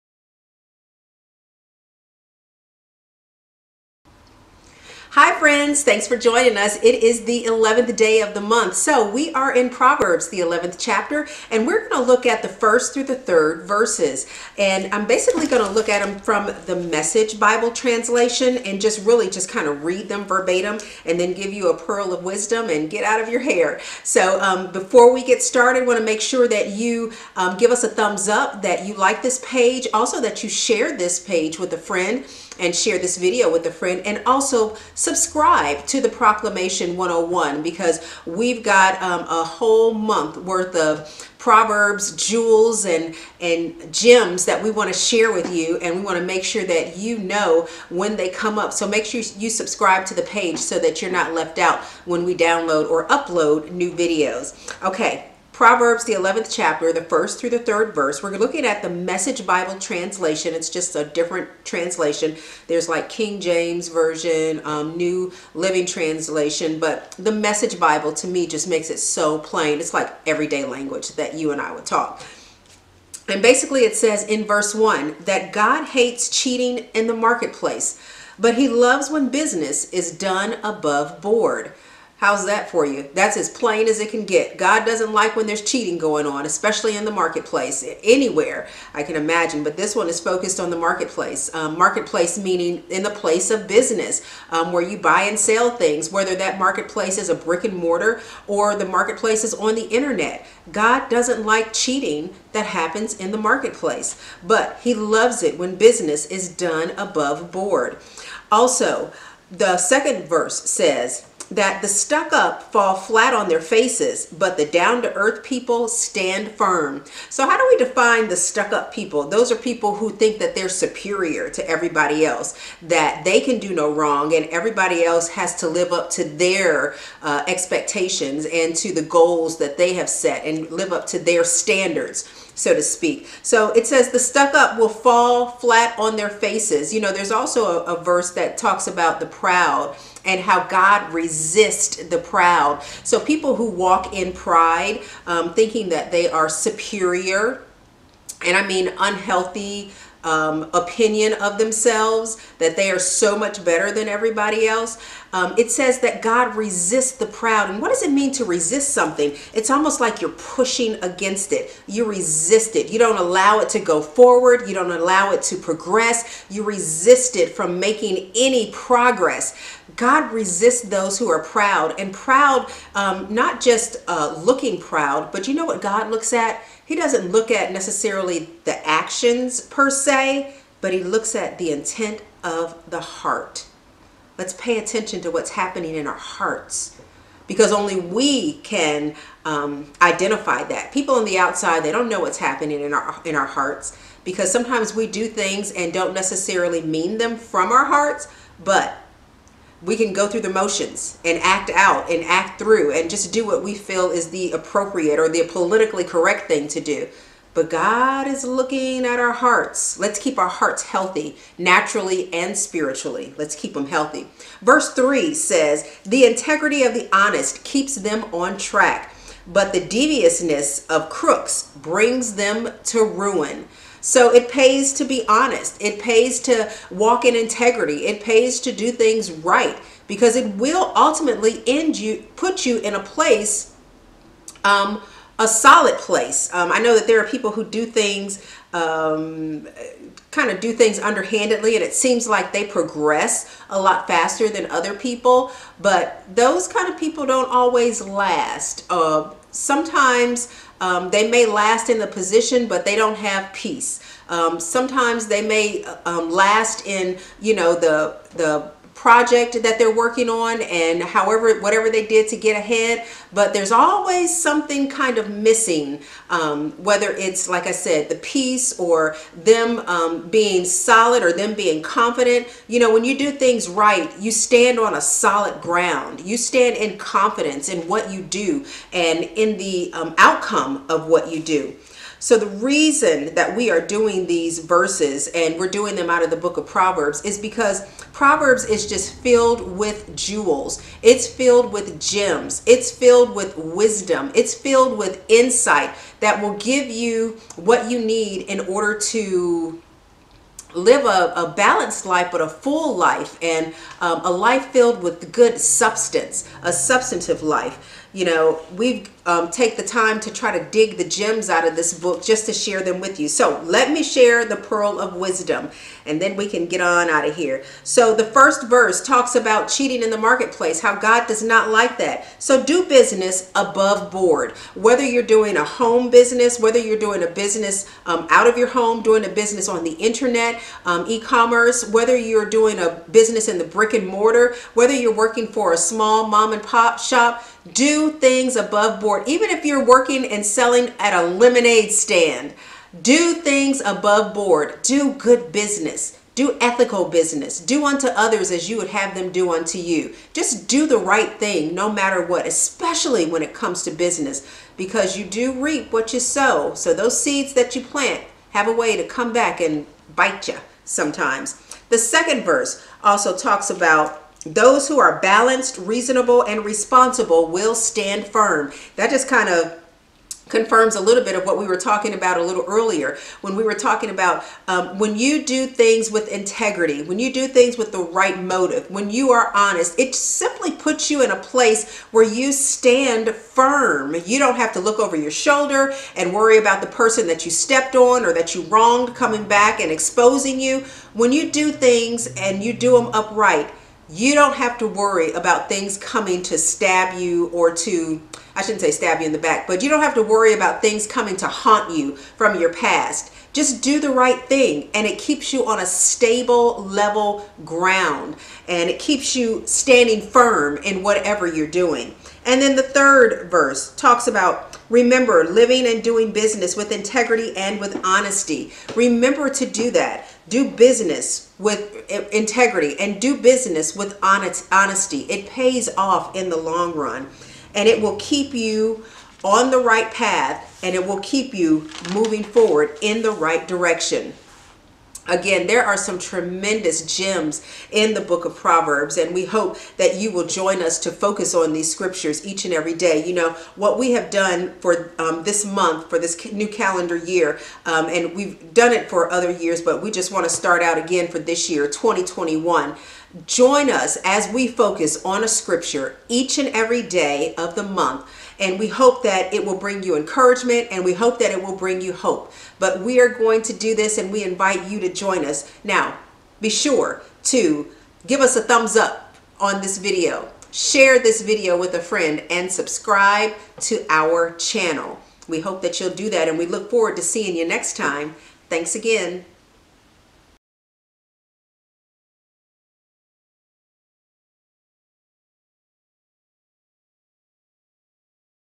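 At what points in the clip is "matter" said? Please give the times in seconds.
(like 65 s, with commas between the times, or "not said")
351 s.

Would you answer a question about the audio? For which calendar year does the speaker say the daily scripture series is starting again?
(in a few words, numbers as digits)
2021.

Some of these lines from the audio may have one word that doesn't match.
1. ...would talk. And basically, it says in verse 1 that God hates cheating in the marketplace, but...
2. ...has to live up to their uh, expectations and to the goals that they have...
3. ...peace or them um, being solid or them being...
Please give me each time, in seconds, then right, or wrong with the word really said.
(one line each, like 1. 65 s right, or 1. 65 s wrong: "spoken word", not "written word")
1. 71 s right
2. 125 s right
3. 268 s right.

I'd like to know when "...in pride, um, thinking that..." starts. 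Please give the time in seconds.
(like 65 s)
144 s.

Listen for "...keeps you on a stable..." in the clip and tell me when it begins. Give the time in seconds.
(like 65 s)
405 s.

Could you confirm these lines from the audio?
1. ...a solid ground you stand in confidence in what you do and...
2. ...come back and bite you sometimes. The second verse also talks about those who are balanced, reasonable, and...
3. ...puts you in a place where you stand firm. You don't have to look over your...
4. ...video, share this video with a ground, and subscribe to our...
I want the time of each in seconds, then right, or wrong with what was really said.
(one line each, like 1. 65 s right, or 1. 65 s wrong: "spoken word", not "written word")
1. 274 s right
2. 359 s right
3. 380 s right
4. 469 s wrong: "friend", not "ground".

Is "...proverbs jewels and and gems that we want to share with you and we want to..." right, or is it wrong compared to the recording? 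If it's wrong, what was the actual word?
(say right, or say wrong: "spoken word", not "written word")
right.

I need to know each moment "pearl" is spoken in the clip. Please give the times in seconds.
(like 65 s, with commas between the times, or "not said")
21 s, 314 s.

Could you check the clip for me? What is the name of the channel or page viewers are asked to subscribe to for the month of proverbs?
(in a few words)
Proclamation 101.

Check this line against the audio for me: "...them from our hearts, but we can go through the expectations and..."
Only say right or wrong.
wrong.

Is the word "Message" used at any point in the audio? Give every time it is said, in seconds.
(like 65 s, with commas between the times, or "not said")
16 s, 58 s, 67 s.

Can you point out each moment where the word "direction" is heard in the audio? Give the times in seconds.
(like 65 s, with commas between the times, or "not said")
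433 s.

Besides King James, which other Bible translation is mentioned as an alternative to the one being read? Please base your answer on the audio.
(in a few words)
New Living Translation.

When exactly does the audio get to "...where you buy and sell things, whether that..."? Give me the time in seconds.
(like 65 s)
94 s.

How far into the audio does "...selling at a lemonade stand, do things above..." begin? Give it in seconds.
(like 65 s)
340 s.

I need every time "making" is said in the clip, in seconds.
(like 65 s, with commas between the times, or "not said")
167 s.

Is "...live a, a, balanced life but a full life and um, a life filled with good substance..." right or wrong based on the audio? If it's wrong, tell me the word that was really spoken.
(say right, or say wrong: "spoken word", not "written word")
right.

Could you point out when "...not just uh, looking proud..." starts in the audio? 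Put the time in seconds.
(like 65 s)
173 s.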